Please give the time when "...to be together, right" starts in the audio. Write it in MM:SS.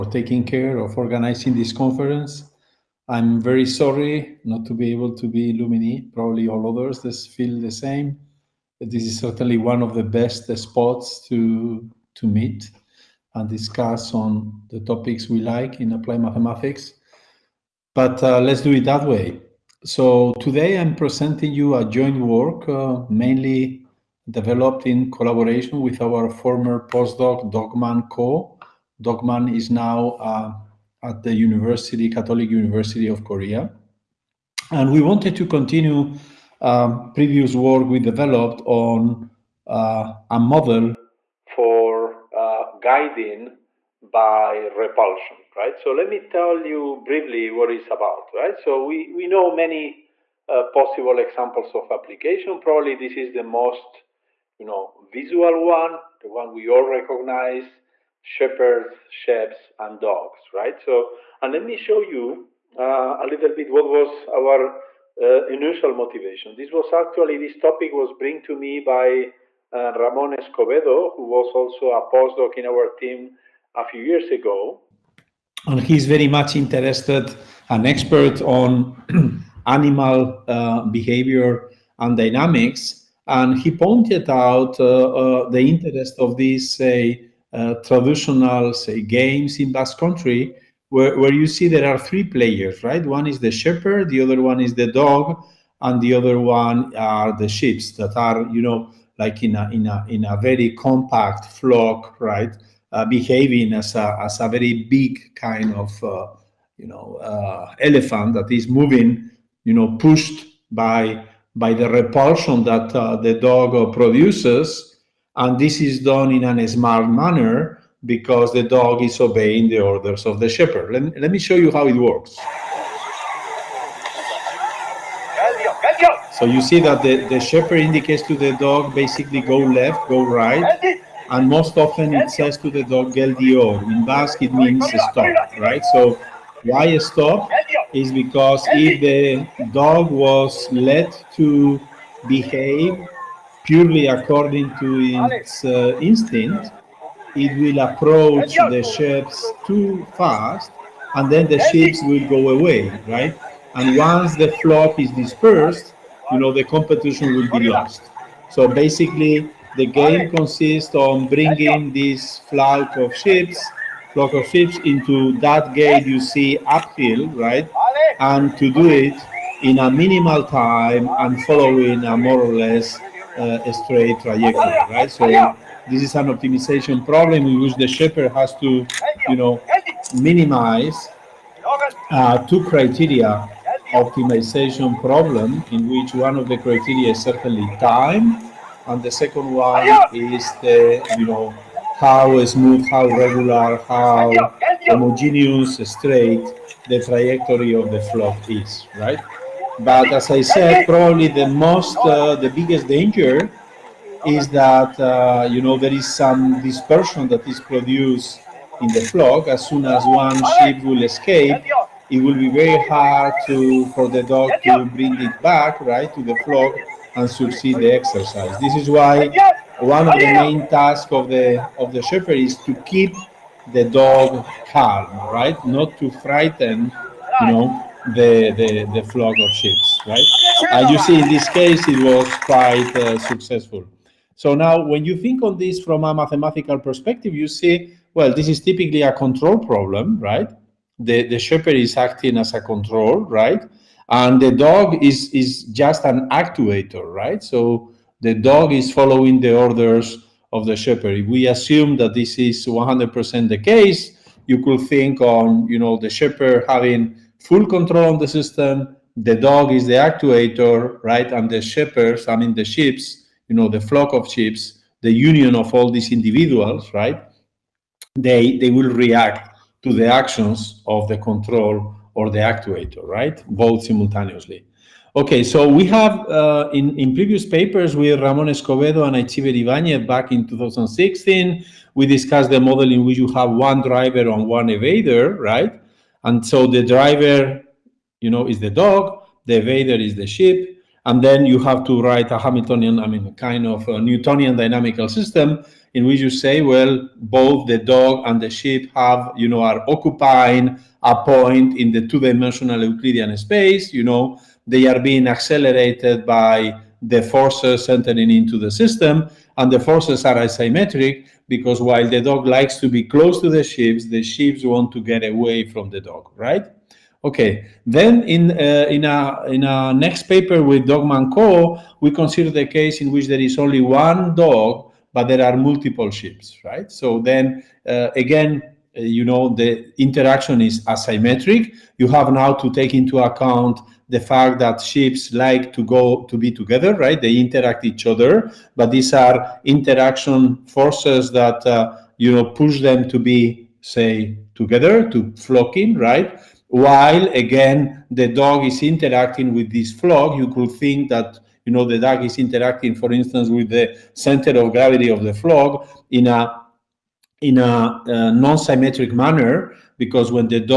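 05:36.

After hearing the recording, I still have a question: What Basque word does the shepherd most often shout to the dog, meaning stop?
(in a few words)
gel.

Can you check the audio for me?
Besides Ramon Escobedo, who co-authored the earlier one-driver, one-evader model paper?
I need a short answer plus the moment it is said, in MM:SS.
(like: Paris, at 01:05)
Aitziber Ibañez, at 04:39.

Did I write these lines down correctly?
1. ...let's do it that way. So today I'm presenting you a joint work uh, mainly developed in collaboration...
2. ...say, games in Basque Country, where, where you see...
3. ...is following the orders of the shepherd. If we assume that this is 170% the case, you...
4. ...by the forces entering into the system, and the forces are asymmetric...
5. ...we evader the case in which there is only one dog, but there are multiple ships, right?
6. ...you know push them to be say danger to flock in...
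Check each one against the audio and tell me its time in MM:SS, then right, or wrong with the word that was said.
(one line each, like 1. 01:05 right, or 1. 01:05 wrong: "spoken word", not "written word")
1. 00:18 right
2. 01:28 right
3. 04:08 wrong: "100", not "170"
4. 05:06 right
5. 05:22 wrong: "consider", not "evader"
6. 05:42 wrong: "together", not "danger".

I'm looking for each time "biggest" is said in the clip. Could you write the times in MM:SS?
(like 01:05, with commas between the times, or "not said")
03:22.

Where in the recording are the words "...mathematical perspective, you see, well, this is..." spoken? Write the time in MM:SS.
03:56.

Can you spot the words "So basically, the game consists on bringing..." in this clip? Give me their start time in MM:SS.
02:38.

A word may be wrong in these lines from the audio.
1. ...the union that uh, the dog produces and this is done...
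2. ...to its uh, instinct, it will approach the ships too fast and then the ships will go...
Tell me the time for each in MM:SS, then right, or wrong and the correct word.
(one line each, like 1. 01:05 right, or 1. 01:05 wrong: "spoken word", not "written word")
1. 01:51 wrong: "repulsion", not "union"
2. 02:24 right.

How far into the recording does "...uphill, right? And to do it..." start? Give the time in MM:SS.
02:46.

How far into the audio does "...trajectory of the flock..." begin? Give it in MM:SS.
03:17.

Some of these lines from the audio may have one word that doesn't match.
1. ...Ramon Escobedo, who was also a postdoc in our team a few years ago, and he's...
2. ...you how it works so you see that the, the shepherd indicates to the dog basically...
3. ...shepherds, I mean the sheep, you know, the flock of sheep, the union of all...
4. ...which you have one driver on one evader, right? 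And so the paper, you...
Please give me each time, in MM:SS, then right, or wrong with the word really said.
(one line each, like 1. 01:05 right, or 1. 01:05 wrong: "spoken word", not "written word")
1. 01:09 right
2. 02:01 right
3. 04:21 right
4. 04:43 wrong: "driver", not "paper".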